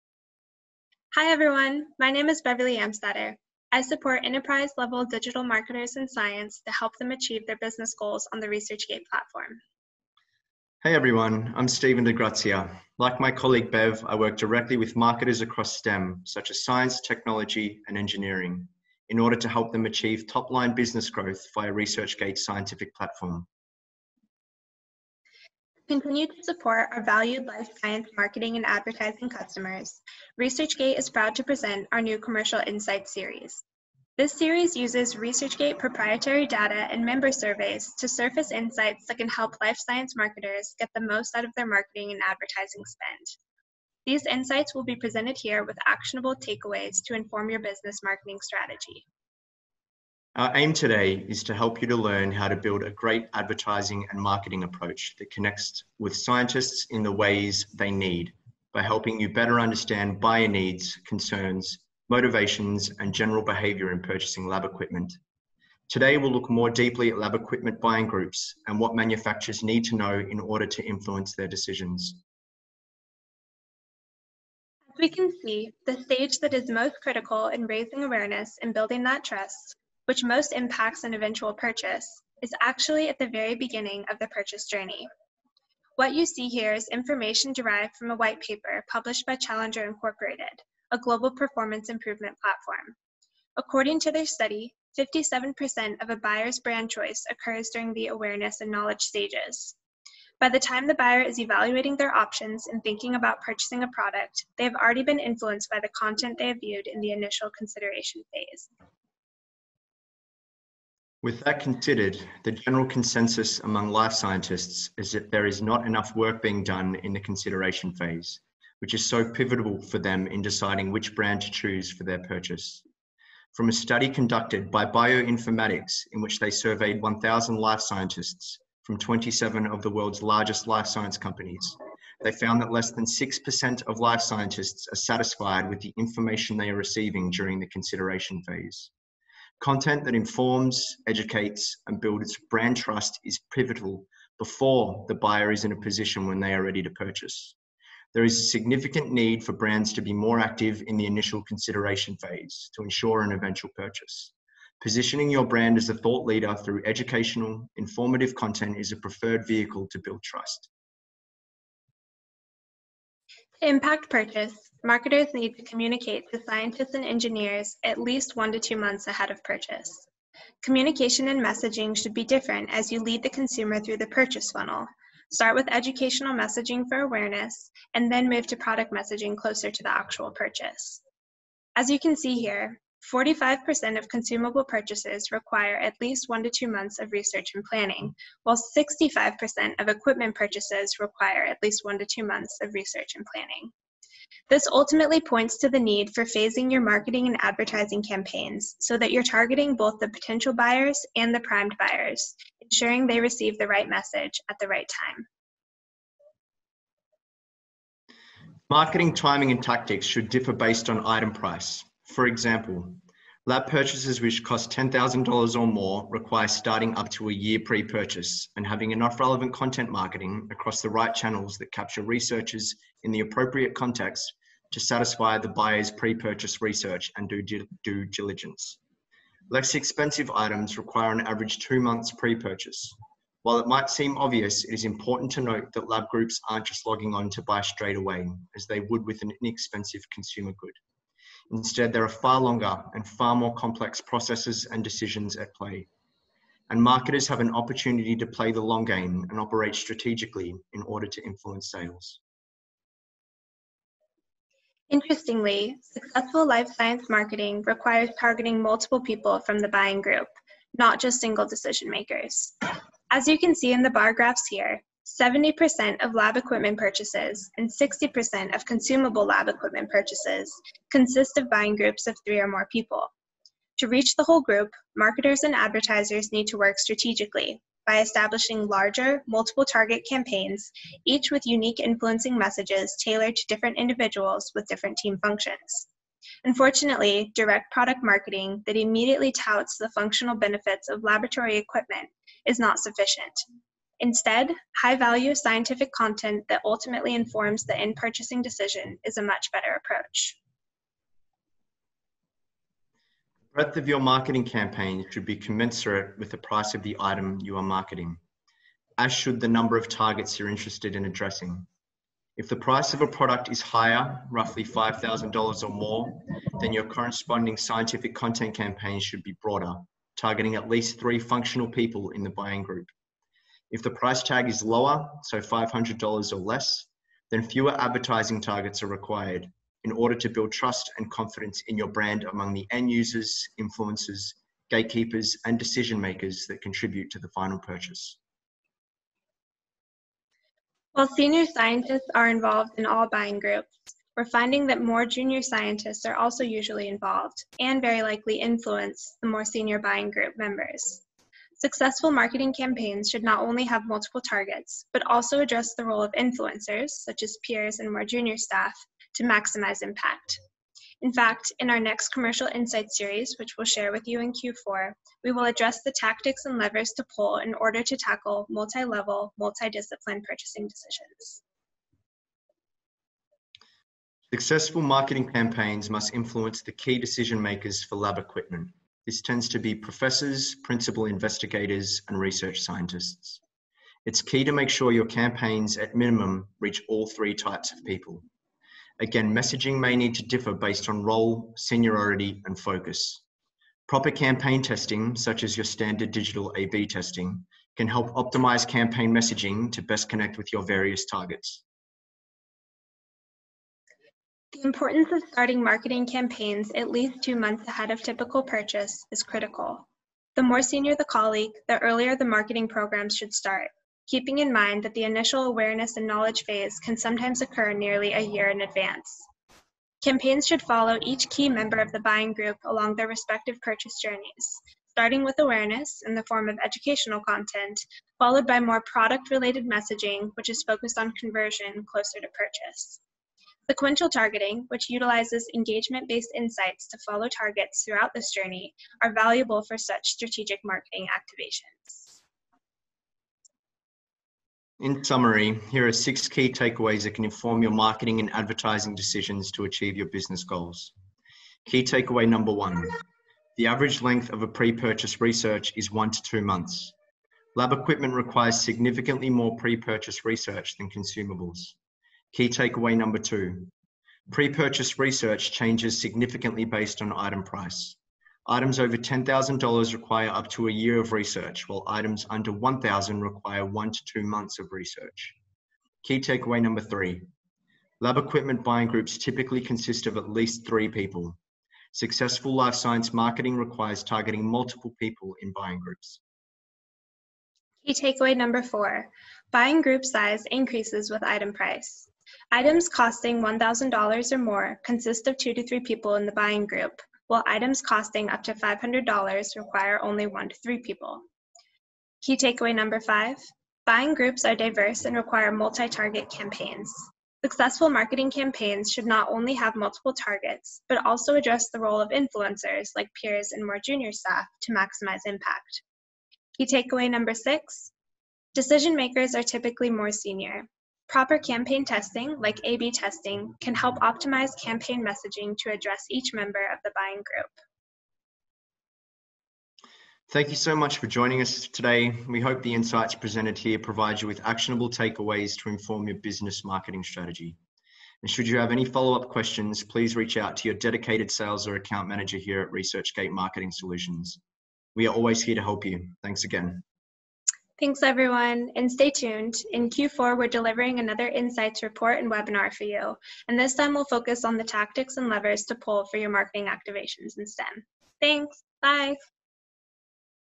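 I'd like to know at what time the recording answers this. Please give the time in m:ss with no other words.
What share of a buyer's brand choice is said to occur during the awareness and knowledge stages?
1:34.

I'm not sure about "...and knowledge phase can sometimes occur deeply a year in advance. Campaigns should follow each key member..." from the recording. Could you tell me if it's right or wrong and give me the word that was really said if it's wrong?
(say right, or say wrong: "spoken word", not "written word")
wrong: "nearly", not "deeply".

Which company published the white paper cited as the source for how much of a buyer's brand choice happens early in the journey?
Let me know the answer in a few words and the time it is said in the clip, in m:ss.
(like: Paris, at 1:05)
Challenger Incorporated, at 1:29.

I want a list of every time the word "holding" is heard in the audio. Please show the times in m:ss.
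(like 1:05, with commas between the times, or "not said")
not said.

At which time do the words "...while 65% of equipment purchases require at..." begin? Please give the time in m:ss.
3:08.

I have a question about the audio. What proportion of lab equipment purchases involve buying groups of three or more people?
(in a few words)
70%.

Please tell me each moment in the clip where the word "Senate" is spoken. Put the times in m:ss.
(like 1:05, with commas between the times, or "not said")
not said.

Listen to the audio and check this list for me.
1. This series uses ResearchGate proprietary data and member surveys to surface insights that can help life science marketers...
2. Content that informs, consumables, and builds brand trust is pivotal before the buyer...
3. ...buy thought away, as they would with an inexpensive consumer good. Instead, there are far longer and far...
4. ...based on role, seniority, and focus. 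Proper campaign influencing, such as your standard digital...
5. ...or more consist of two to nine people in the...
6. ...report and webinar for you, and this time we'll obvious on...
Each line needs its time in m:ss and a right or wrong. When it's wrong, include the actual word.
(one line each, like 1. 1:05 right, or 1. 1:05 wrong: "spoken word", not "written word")
1. 0:34 right
2. 2:19 wrong: "educates", not "consumables"
3. 3:57 wrong: "straight", not "thought"
4. 6:30 wrong: "testing", not "influencing"
5. 8:14 wrong: "three", not "nine"
6. 9:11 wrong: "focus", not "obvious".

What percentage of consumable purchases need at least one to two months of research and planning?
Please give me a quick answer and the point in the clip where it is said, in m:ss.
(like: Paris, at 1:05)
45%, at 3:03.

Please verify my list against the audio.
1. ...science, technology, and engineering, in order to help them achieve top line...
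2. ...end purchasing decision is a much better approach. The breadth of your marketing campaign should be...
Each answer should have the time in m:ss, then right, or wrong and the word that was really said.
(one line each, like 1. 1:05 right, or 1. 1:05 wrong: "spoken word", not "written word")
1. 0:16 right
2. 4:57 right.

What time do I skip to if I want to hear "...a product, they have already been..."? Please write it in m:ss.
1:43.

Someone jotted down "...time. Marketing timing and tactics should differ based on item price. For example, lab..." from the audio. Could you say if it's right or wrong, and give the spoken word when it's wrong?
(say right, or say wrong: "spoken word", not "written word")
right.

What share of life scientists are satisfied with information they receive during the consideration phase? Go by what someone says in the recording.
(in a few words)
less than 6%.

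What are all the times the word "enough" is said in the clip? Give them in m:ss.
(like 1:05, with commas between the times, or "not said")
1:55, 3:38.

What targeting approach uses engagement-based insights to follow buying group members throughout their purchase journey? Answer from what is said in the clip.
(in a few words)
Sequential targeting.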